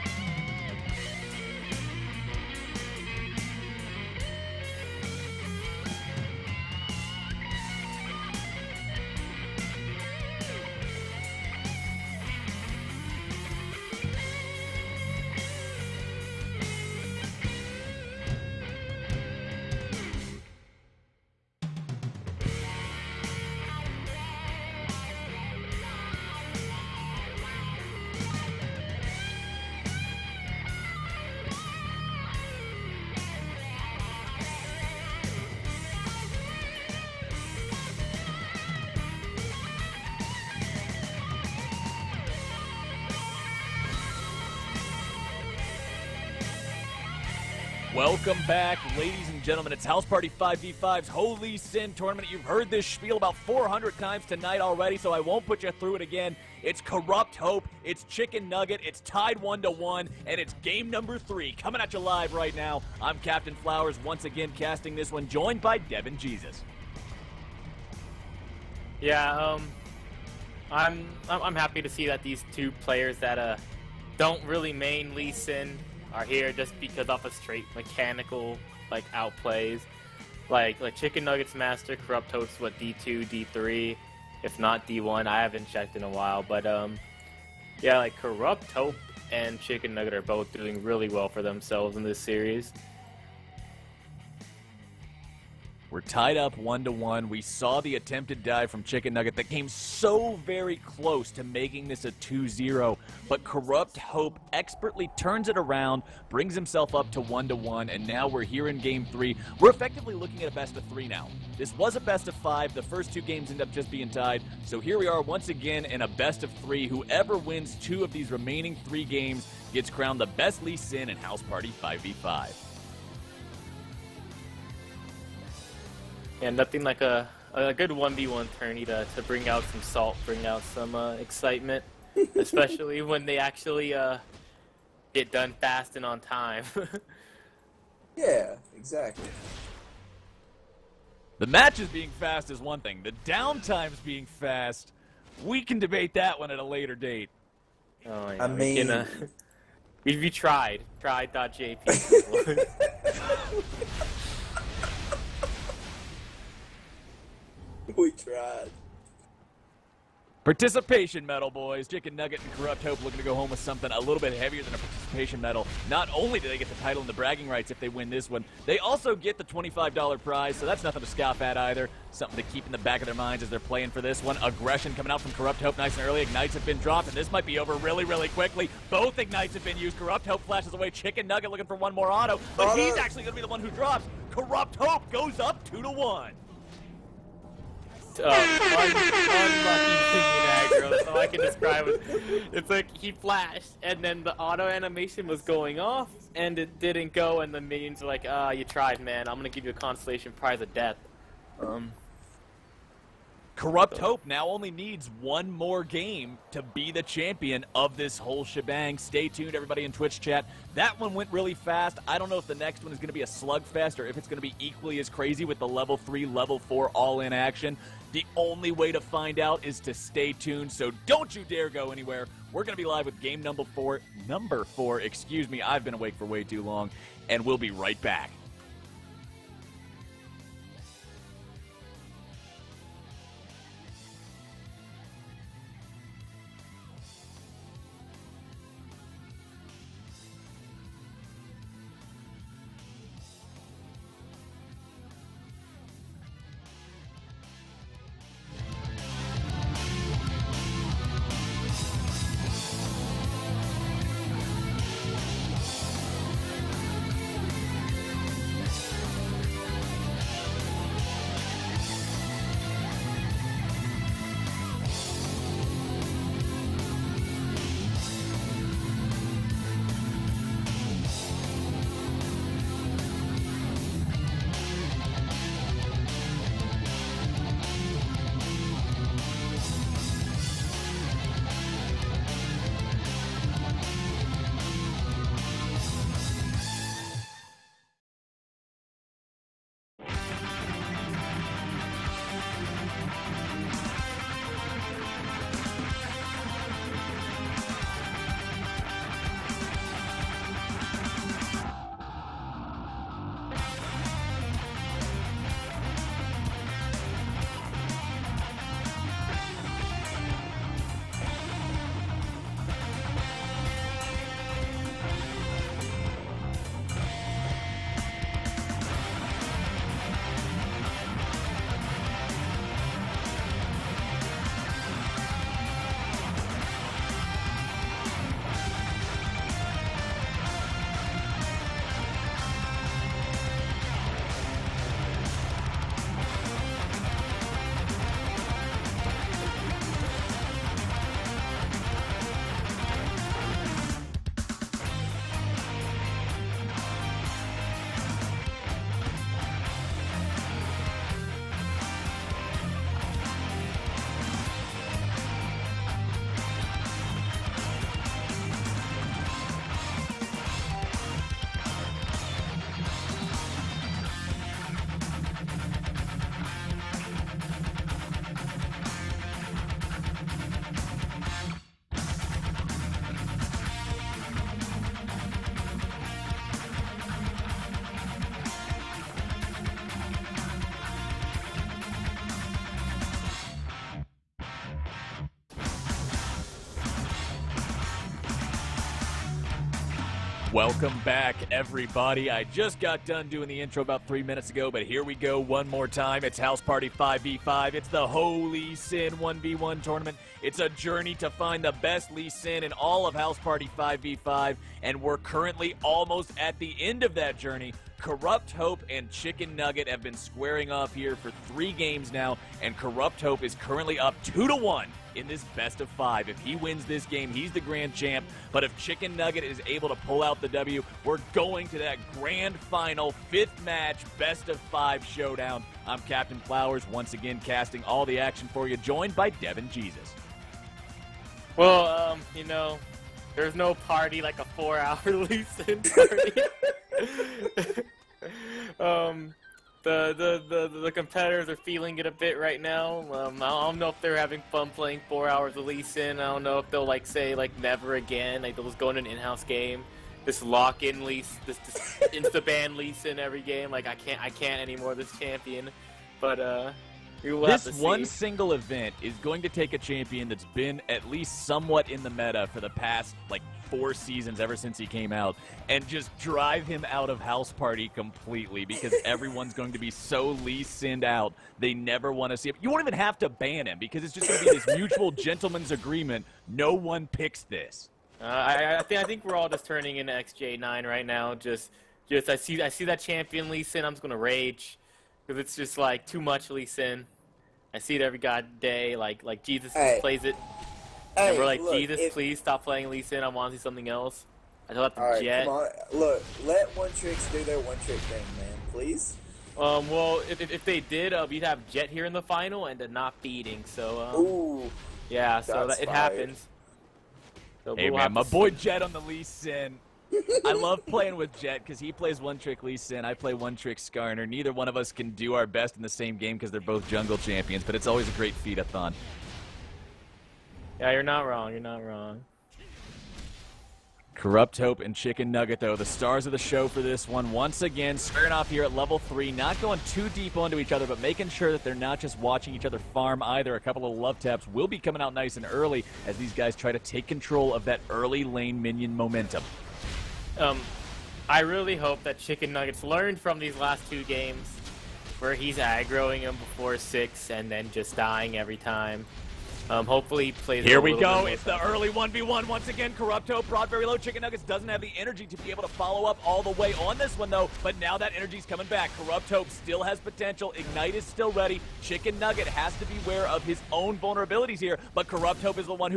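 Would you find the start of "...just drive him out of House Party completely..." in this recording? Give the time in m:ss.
7:45.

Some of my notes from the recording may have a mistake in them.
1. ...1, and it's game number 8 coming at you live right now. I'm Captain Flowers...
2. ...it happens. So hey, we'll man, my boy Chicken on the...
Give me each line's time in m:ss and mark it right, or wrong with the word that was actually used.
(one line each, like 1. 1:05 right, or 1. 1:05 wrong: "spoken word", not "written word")
1. 0:59 wrong: "3", not "8"
2. 8:25 wrong: "Jet", not "Chicken".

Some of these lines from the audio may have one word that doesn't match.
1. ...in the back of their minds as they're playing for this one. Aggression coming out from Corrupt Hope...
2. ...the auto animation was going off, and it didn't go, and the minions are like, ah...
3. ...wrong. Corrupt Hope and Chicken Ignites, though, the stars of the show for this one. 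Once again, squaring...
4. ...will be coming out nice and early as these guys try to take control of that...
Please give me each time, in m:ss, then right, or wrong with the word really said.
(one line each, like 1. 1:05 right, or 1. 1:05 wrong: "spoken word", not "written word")
1. 2:52 right
2. 3:14 right
3. 8:41 wrong: "Nugget", not "Ignites"
4. 8:54 right.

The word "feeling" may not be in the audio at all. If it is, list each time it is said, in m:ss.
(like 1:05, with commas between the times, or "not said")
7:21.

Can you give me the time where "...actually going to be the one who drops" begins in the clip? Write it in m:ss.
3:02.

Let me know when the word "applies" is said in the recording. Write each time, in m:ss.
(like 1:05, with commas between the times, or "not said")
not said.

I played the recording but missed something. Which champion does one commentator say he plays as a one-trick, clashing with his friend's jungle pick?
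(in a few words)
Skarner.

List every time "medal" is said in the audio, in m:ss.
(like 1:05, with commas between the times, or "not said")
2:41, 2:45.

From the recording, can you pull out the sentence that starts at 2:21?
The matches being fast is one thing.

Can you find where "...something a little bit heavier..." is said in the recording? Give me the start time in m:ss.
2:43.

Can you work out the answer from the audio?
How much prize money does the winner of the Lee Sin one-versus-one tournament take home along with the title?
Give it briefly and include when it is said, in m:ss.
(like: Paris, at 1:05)
$25, at 2:49.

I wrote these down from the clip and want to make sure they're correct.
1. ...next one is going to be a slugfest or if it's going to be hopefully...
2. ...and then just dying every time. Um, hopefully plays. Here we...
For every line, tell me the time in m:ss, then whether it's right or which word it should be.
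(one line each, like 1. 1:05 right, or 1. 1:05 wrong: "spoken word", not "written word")
1. 3:32 wrong: "equally", not "hopefully"
2. 9:07 right.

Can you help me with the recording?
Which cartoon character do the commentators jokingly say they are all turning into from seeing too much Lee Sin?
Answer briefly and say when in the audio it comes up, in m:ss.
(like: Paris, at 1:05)
XJ9, at 8:00.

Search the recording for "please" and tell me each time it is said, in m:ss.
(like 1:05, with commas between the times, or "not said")
8:12, 8:18.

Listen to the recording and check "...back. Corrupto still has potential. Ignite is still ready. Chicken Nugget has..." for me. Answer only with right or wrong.
right.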